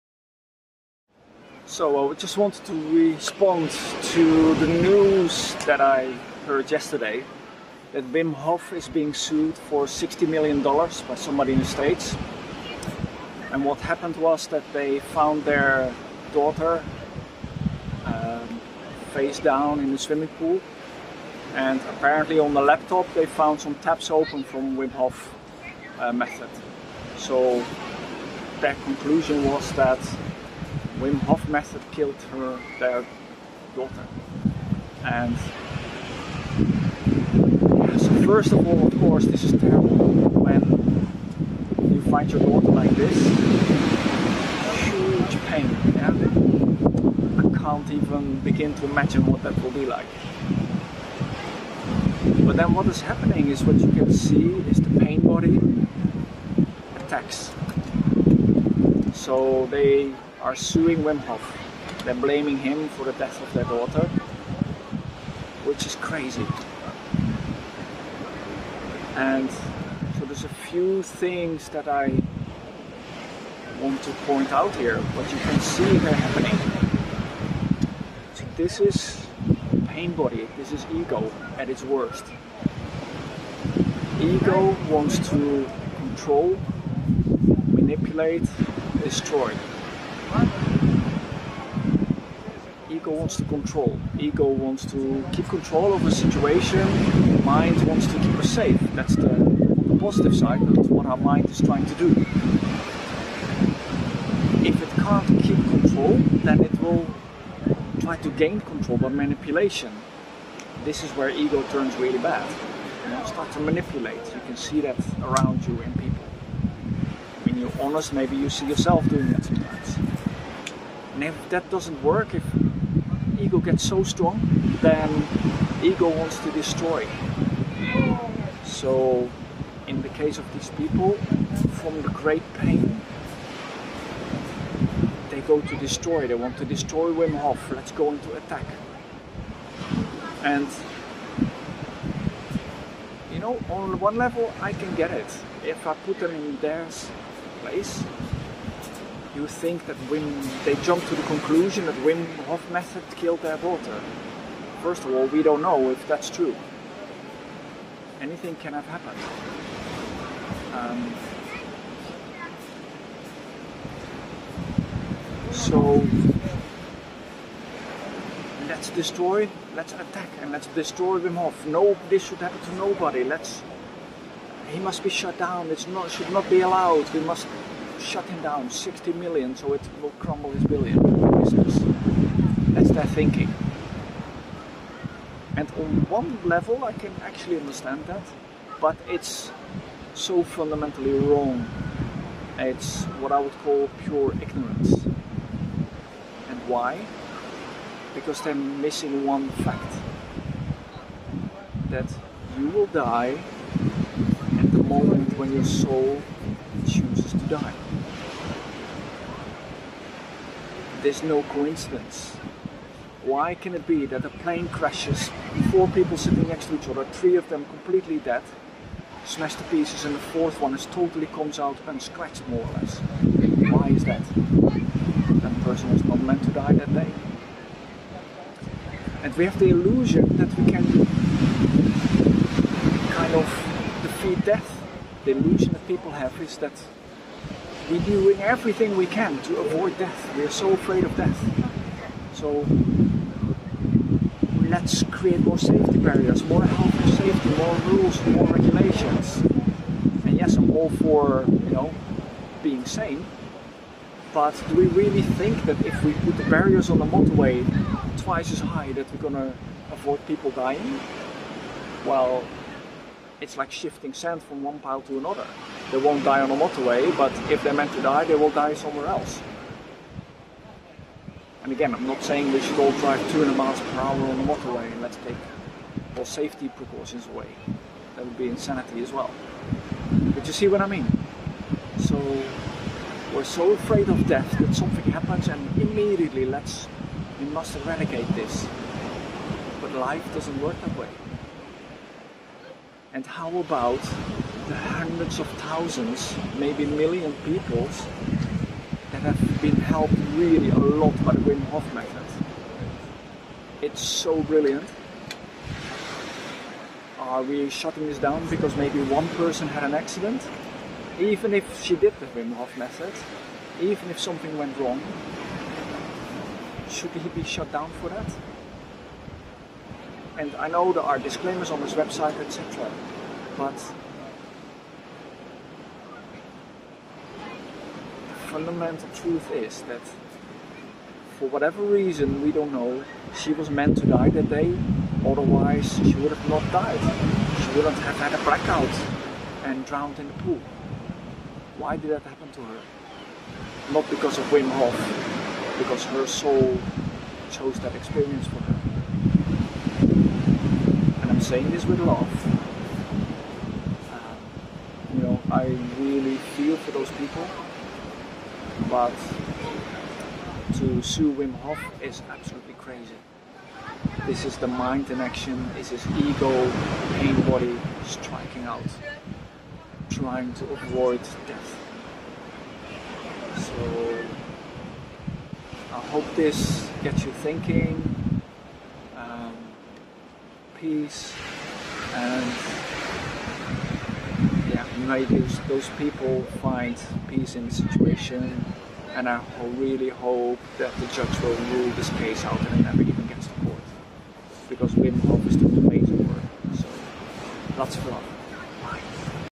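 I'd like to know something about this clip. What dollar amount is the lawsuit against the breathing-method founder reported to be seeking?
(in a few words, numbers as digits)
60 million dollars.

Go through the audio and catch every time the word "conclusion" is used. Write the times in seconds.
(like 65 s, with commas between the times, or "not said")
28 s, 151 s.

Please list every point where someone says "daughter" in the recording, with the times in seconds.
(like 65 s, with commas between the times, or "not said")
16 s, 33 s, 42 s, 63 s, 153 s.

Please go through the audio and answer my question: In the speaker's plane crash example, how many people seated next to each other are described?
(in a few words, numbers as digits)
4.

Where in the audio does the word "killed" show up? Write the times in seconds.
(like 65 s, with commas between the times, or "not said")
31 s, 153 s.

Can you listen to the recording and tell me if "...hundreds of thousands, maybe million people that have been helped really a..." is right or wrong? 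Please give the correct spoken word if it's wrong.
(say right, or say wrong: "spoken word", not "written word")
right.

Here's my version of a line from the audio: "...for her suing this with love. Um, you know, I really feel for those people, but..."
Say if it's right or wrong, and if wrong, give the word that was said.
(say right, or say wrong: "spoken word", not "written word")
wrong: "saying", not "suing".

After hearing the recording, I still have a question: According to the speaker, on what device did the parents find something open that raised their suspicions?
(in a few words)
laptop.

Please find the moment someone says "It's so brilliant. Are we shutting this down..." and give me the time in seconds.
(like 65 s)
303 s.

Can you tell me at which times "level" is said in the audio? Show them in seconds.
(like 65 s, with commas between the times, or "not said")
144 s, 186 s.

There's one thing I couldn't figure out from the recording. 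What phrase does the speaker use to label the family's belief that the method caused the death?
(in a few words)
pure ignorance.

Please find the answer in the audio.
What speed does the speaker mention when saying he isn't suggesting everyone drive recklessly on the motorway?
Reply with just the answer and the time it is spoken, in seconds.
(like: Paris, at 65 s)
200 miles per hour, at 273 s.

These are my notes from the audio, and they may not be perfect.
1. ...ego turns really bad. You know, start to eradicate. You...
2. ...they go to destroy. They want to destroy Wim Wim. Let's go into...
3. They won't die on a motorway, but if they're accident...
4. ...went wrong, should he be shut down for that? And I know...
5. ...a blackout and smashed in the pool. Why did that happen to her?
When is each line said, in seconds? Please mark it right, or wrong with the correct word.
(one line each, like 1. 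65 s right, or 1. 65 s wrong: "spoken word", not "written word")
1. 111 s wrong: "manipulate", not "eradicate"
2. 135 s wrong: "Hof", not "Wim"
3. 265 s wrong: "meant", not "accident"
4. 314 s right
5. 338 s wrong: "drowned", not "smashed".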